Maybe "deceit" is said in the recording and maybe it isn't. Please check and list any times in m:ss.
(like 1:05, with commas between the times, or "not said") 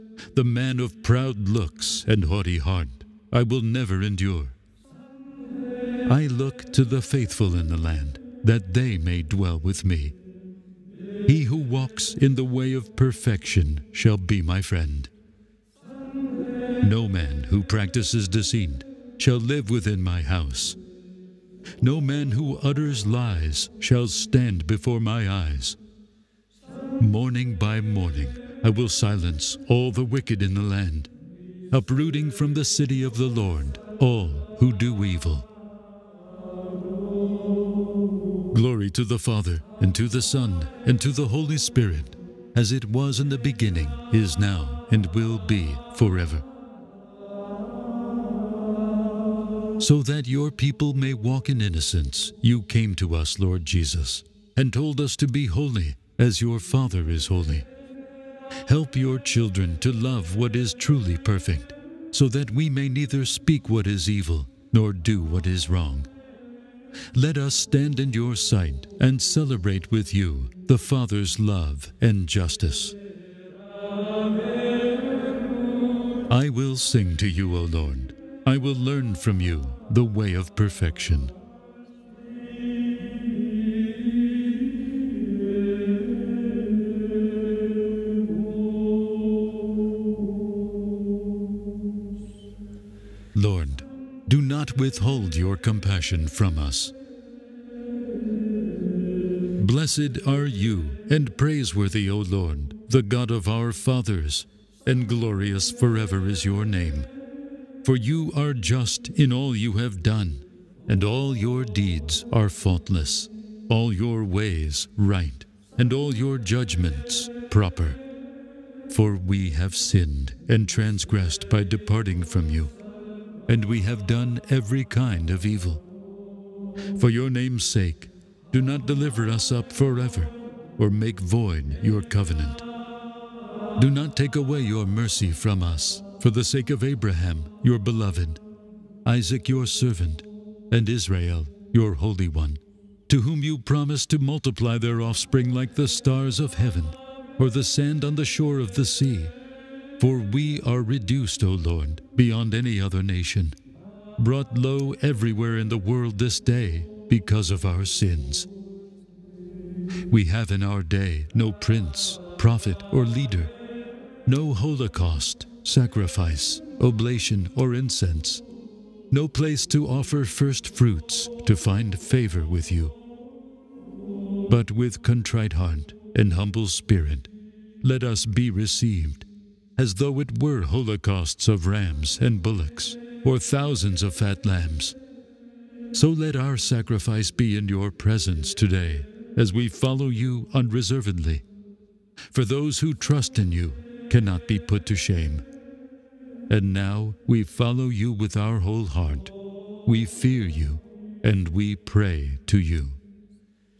0:18.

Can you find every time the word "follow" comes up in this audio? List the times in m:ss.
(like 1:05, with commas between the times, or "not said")
3:09, 3:17.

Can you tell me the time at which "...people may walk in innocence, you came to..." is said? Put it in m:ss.
0:50.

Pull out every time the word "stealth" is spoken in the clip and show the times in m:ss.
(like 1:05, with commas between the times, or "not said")
not said.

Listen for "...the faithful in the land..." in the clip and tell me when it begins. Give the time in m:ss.
0:06.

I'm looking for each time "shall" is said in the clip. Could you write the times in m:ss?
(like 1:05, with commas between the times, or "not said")
0:13, 0:19, 0:23.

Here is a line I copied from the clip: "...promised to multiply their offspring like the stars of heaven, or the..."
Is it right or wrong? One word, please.
right.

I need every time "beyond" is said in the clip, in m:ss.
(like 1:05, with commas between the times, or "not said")
2:32.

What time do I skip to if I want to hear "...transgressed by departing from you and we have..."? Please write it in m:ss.
2:00.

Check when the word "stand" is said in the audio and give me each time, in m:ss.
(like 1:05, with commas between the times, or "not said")
0:24, 1:07.